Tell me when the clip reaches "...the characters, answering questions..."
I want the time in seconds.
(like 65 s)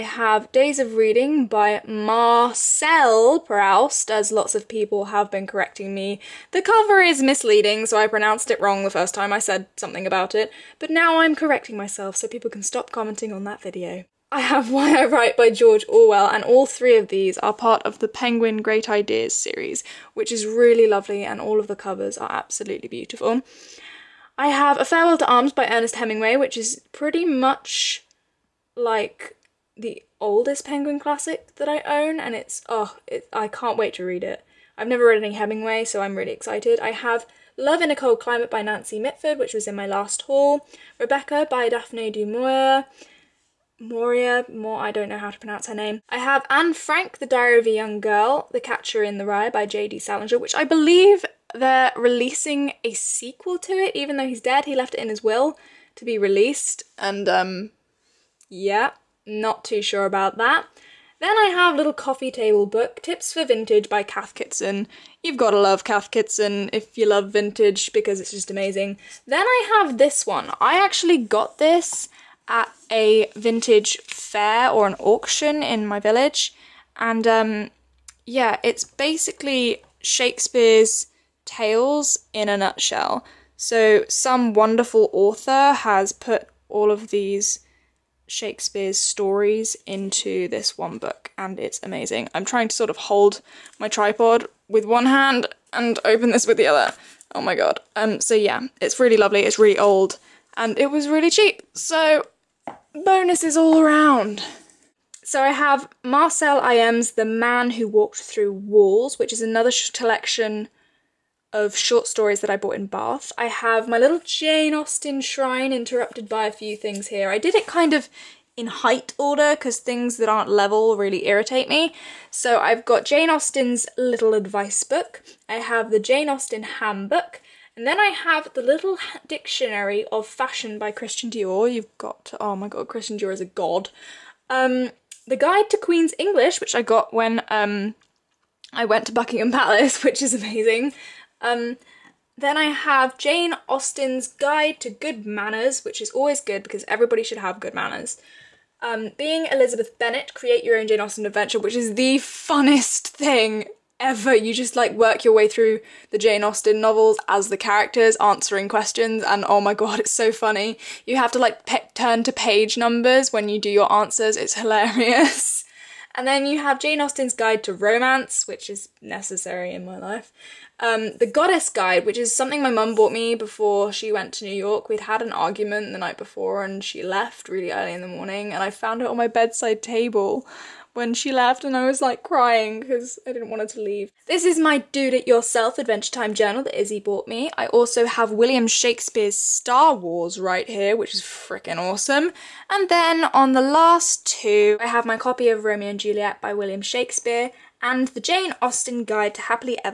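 157 s.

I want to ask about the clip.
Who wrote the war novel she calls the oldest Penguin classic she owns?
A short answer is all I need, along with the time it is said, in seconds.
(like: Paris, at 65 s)
Ernest Hemingway, at 25 s.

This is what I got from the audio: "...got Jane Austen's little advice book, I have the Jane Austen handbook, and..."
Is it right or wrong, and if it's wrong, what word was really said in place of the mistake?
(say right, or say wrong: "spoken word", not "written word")
right.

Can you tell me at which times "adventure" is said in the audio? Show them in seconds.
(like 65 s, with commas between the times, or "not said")
151 s, 185 s.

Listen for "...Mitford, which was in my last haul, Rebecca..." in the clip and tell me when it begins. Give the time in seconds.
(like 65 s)
38 s.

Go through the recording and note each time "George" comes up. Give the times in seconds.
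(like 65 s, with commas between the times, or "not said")
15 s.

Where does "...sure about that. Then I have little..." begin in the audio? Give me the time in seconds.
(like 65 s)
59 s.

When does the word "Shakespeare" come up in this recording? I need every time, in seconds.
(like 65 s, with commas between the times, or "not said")
80 s, 88 s, 188 s, 196 s.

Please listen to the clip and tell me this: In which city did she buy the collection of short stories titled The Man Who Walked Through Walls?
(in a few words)
Bath.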